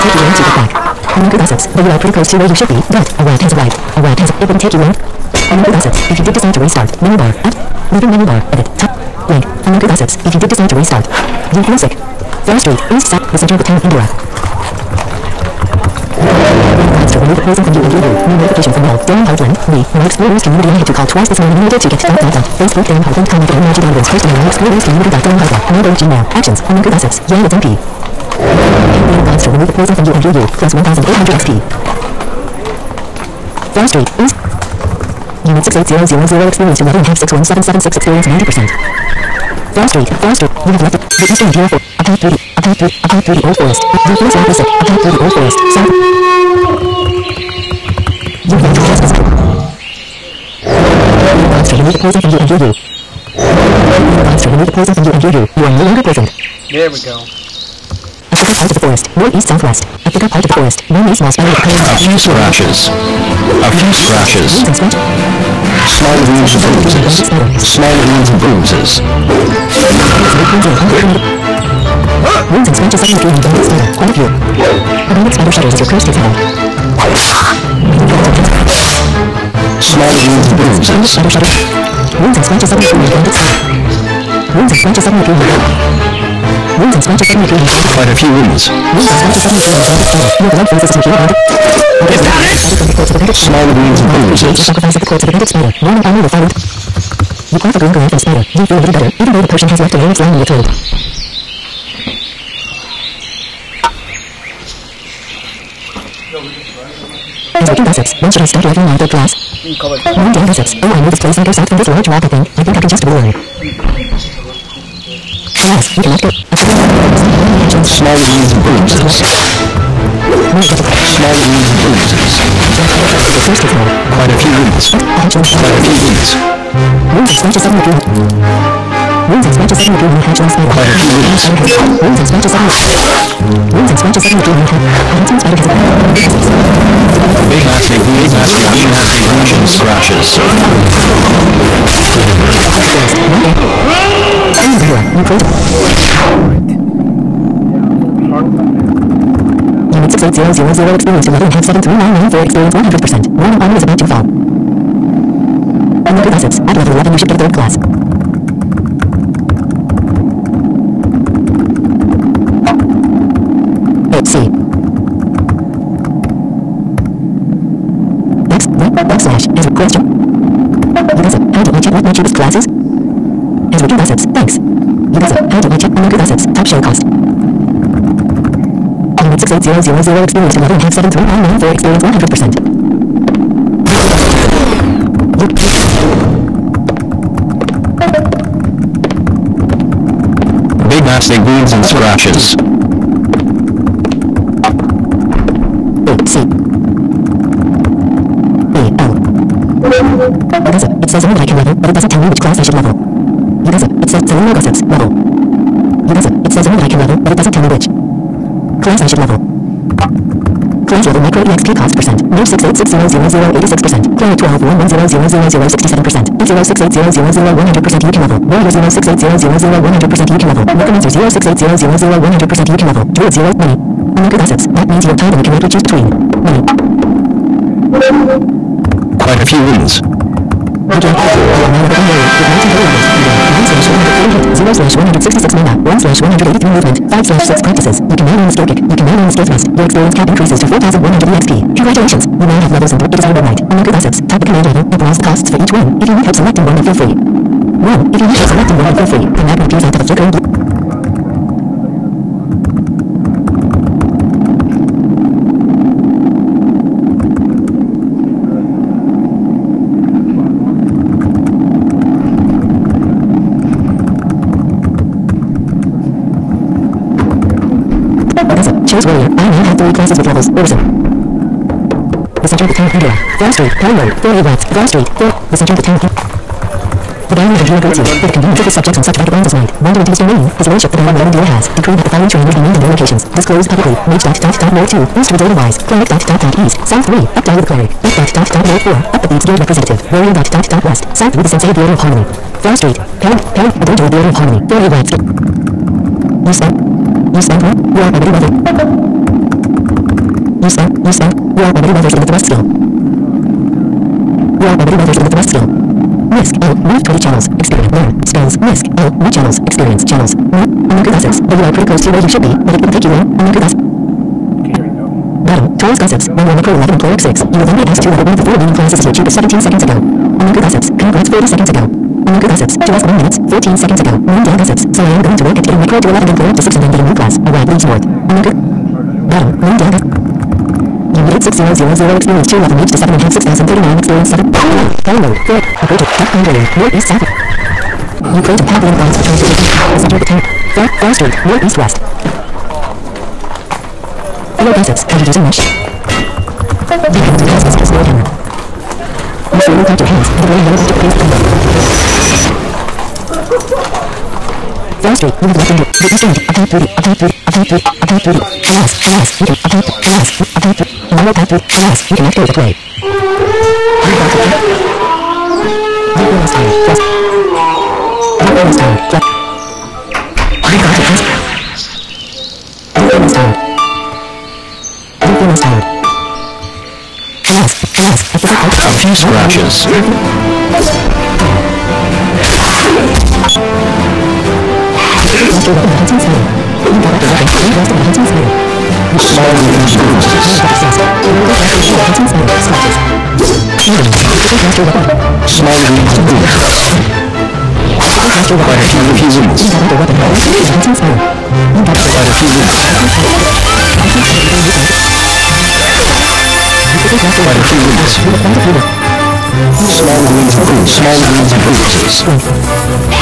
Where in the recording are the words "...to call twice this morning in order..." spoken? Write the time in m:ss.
0:20.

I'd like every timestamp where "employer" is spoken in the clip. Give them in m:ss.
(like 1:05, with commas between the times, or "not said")
5:16, 5:26.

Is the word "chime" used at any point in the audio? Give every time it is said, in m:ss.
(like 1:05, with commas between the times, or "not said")
not said.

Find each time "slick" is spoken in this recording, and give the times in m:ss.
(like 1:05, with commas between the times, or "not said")
not said.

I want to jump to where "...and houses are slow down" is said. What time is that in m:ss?
5:47.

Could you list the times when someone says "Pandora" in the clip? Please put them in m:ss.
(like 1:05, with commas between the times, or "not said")
4:32.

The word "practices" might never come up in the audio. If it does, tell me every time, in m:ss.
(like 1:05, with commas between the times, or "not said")
3:57.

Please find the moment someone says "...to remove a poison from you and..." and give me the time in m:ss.
0:29.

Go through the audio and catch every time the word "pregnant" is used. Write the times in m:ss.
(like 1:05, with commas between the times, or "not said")
not said.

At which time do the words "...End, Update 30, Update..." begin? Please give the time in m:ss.
5:56.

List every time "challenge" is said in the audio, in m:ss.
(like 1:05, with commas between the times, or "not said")
not said.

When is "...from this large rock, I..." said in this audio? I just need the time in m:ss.
1:51.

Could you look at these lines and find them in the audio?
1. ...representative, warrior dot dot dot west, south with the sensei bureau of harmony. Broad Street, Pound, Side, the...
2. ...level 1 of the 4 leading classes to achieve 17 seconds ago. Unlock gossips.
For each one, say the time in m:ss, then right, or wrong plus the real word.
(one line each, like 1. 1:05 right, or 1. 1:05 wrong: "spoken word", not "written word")
1. 4:49 wrong: "Pound", not "Side"
2. 5:18 right.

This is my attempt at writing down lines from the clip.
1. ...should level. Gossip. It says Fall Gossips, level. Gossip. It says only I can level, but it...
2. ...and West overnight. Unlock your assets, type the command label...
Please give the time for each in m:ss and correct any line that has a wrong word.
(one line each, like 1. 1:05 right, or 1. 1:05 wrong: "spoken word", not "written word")
1. 3:22 wrong: "Selena", not "Fall"
2. 4:02 wrong: "One", not "West".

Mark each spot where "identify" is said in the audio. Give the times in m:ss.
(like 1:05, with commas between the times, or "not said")
not said.